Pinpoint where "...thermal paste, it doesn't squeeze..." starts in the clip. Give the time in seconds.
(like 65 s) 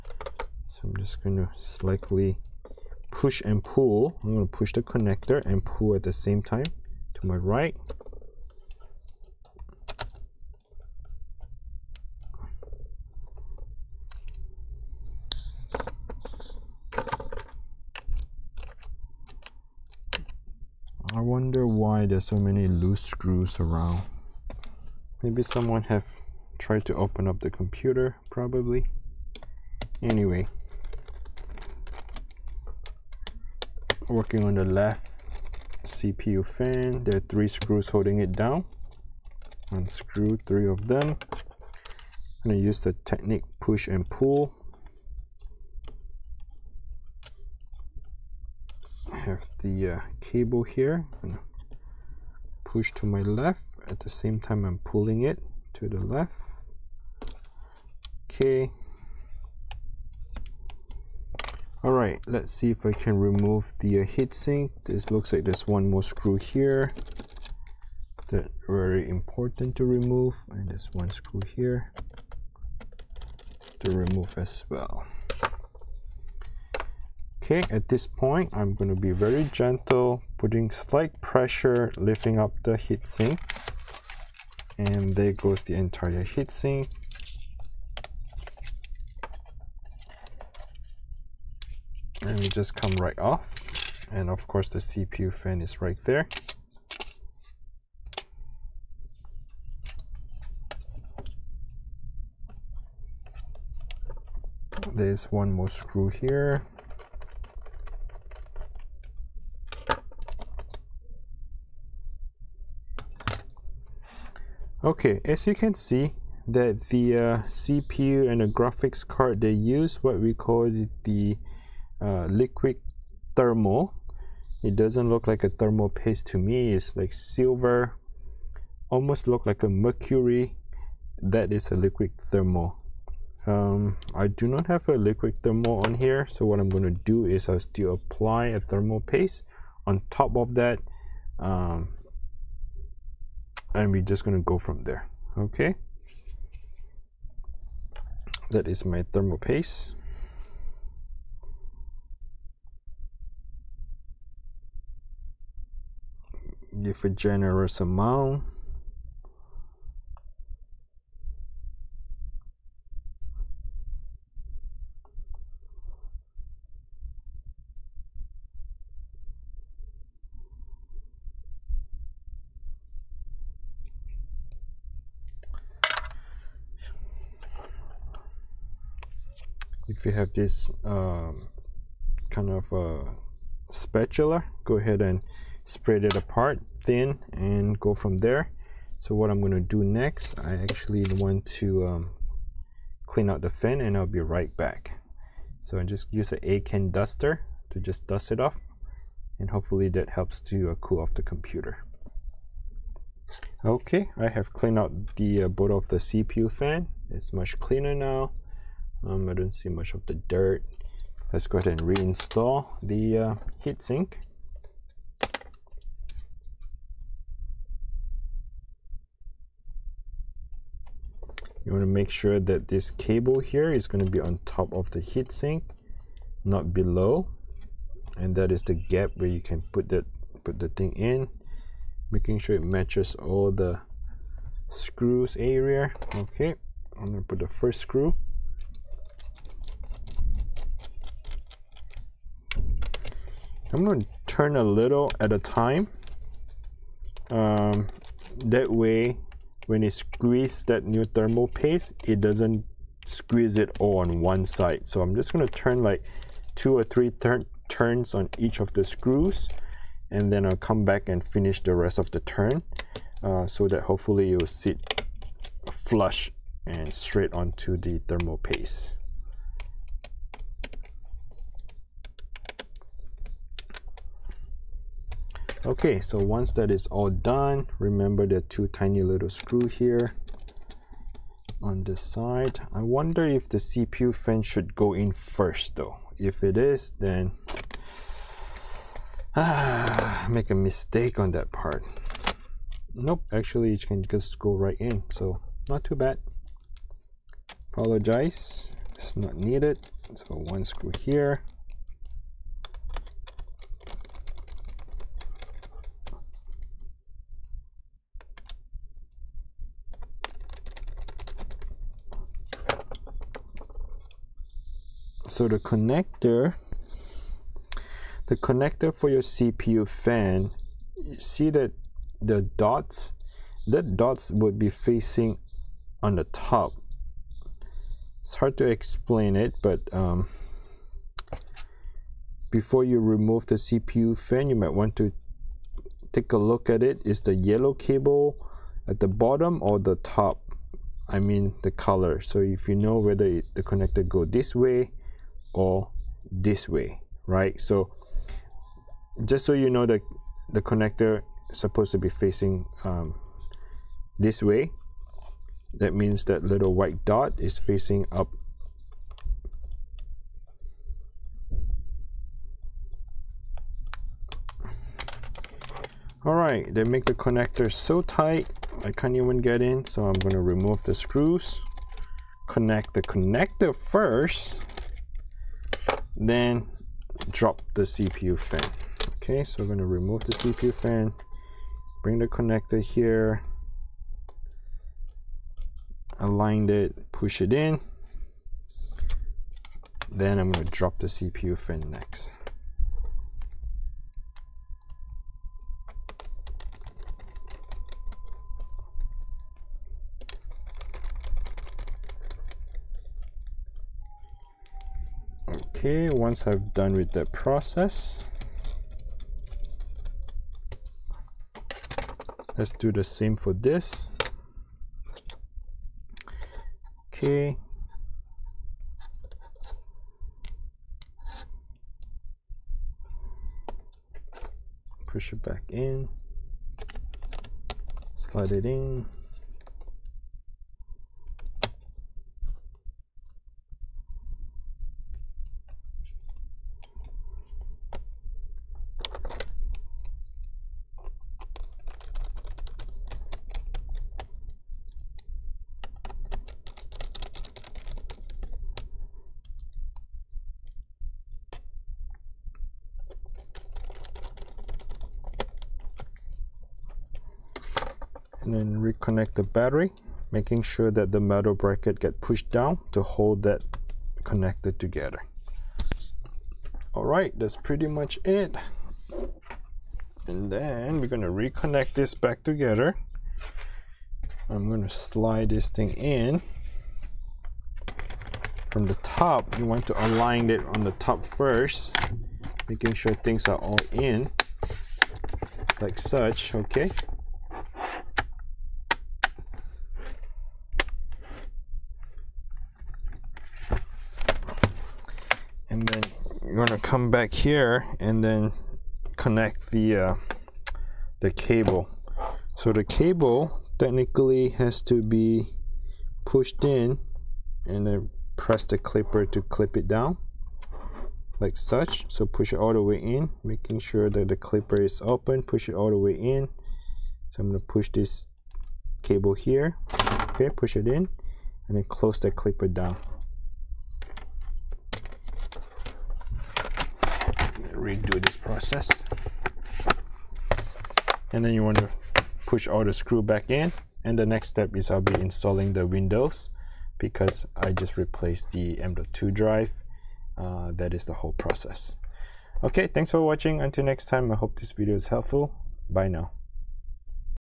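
251 s.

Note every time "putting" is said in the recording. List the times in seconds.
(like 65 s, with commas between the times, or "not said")
80 s.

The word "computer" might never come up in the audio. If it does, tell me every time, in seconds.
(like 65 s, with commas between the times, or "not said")
27 s, 201 s.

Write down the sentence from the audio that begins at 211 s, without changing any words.
Let's go ahead and reinstall the uh, heatsink.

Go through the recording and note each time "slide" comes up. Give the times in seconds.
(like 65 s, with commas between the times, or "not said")
428 s, 474 s.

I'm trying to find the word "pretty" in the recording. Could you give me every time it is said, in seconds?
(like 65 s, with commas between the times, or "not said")
467 s.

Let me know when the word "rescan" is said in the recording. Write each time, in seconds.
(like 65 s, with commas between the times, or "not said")
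not said.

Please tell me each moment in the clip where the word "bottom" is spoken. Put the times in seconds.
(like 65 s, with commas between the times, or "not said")
339 s.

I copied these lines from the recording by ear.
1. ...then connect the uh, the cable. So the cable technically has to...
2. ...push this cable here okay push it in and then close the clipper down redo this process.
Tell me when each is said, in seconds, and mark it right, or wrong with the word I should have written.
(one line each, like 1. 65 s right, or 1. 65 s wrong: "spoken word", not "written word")
1. 498 s right
2. 517 s right.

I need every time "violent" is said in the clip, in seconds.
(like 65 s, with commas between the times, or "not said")
not said.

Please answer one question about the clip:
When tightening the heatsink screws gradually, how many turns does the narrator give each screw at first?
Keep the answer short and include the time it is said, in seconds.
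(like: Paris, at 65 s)
2 or 3, at 256 s.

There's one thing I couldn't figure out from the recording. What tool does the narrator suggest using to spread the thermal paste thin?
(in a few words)
Spatula.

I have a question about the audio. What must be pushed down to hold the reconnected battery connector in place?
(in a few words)
Metal bracket.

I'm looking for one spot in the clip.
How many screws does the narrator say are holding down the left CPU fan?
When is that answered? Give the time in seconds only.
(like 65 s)
37 s.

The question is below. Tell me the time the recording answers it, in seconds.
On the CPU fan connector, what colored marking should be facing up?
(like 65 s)
356 s.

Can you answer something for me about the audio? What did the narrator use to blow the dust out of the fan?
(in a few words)
A can duster.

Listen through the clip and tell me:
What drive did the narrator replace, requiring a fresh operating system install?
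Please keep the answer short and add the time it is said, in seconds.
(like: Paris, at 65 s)
M.2 drive, at 538 s.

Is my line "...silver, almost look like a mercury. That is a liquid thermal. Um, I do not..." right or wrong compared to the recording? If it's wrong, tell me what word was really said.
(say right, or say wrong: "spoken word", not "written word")
right.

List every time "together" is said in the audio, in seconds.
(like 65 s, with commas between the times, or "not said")
464 s, 472 s.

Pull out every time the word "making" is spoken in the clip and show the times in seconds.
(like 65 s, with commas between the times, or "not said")
232 s, 460 s, 482 s, 513 s.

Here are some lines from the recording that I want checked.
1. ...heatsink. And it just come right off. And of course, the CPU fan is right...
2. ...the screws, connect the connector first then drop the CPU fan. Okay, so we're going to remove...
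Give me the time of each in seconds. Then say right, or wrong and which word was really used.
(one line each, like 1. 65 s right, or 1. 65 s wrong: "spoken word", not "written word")
1. 86 s right
2. 370 s right.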